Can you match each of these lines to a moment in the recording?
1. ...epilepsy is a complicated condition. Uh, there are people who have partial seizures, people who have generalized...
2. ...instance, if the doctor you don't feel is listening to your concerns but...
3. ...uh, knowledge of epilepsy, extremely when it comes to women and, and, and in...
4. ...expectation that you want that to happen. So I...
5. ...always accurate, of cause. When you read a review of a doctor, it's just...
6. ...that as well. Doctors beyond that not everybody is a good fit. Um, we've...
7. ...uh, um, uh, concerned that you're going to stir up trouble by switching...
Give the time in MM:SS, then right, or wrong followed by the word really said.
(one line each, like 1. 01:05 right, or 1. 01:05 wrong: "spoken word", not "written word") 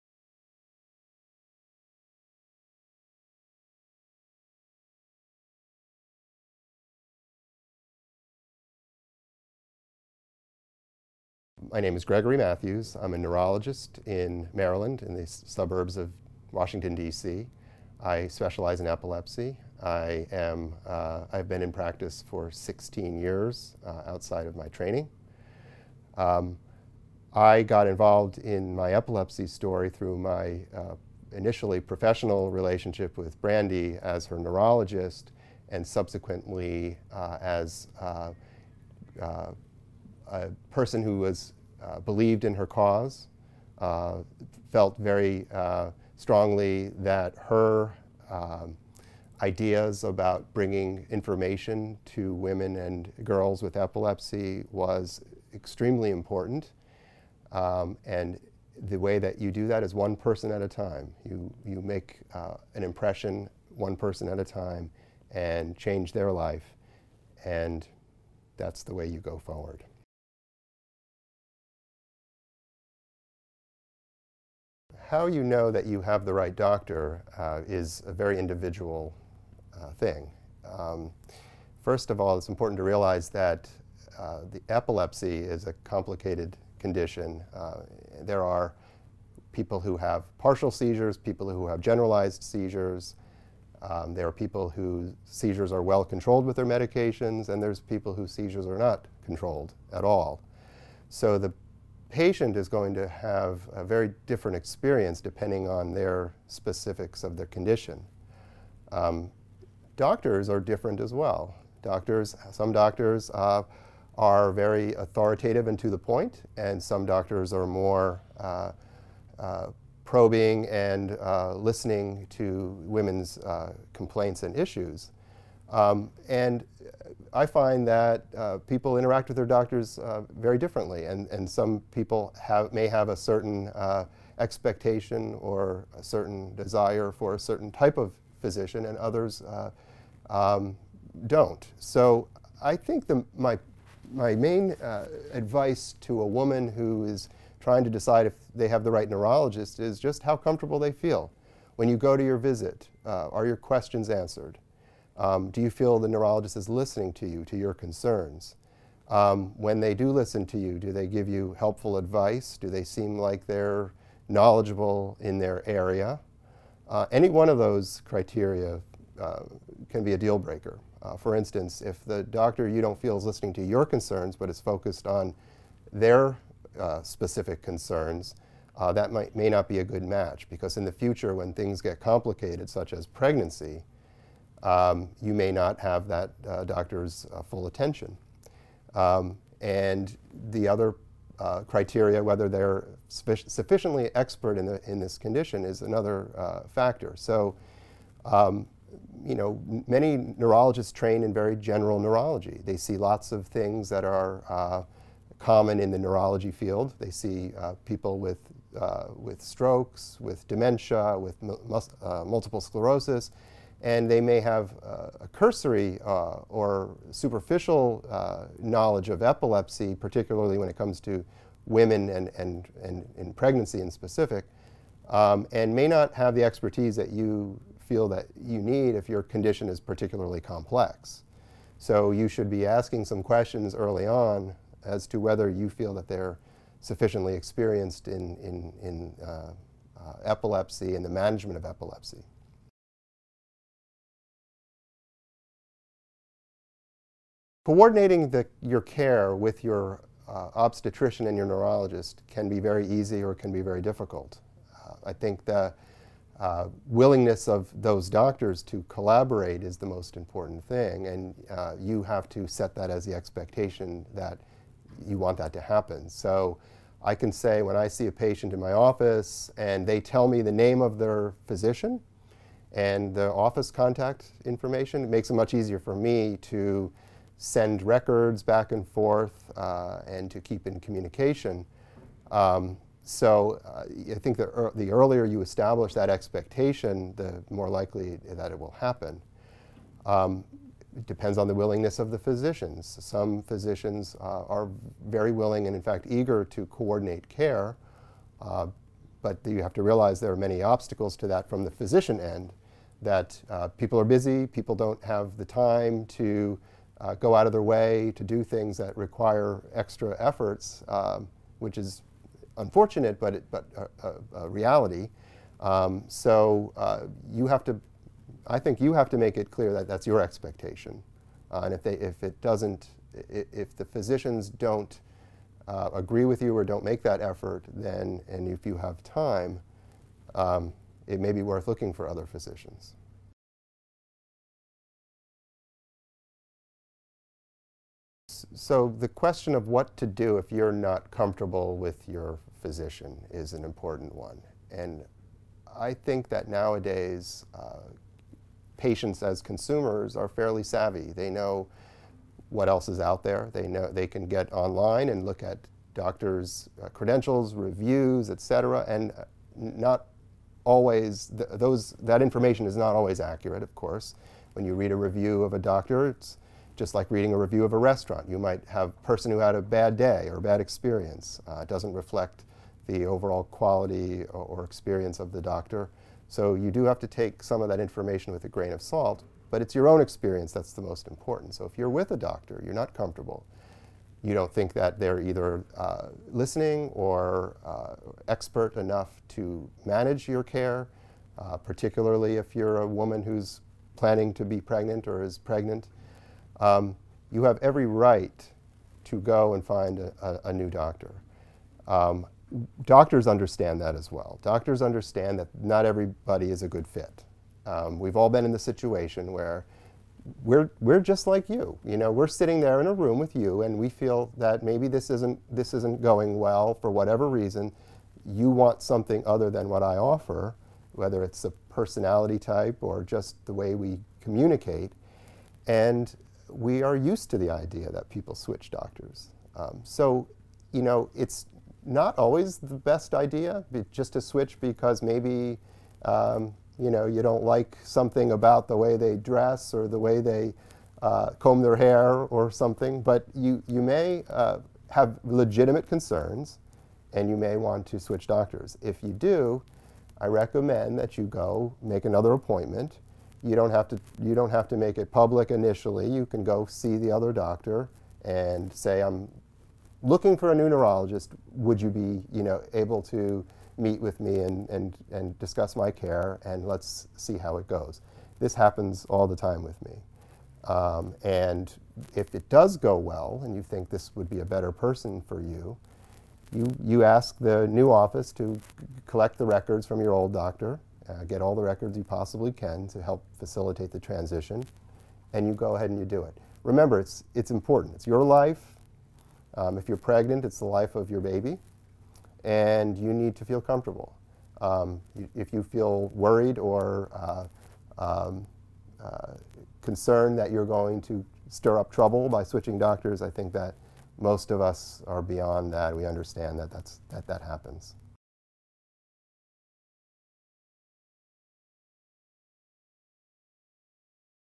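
1. 01:24 right
2. 02:51 right
3. 03:38 wrong: "particularly", not "extremely"
4. 04:23 right
5. 06:02 wrong: "course", not "cause"
6. 06:43 wrong: "understand", not "beyond"
7. 08:17 right.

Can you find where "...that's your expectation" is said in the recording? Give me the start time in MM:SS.
05:19.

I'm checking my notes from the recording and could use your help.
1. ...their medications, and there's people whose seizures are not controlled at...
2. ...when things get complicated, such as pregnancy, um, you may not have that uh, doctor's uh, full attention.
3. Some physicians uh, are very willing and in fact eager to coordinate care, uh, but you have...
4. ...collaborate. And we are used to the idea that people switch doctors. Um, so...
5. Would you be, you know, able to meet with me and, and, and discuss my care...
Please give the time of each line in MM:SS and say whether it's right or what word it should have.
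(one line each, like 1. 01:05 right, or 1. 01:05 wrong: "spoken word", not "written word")
1. 01:36 right
2. 03:01 right
3. 04:53 right
4. 07:04 wrong: "communicate", not "collaborate"
5. 07:41 right.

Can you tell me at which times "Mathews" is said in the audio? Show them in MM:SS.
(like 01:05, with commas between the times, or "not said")
00:12.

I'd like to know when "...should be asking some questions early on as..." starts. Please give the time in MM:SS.
03:52.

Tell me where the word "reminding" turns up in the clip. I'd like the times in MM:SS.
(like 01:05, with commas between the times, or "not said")
not said.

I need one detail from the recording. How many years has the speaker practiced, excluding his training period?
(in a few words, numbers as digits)
16.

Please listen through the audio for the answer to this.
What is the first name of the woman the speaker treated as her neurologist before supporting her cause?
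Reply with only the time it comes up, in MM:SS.
00:33.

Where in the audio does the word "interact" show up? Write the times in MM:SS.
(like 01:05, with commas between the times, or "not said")
02:08.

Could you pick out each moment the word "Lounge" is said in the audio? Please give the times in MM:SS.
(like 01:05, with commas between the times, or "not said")
not said.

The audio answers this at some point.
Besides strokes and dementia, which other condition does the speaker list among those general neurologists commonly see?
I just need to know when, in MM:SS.
03:31.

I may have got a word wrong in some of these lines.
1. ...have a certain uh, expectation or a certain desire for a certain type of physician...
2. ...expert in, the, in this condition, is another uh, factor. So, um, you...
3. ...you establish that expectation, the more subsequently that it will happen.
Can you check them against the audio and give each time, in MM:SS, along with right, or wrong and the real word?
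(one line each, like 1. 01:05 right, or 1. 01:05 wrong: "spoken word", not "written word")
1. 02:12 right
2. 03:14 right
3. 04:45 wrong: "likely", not "subsequently".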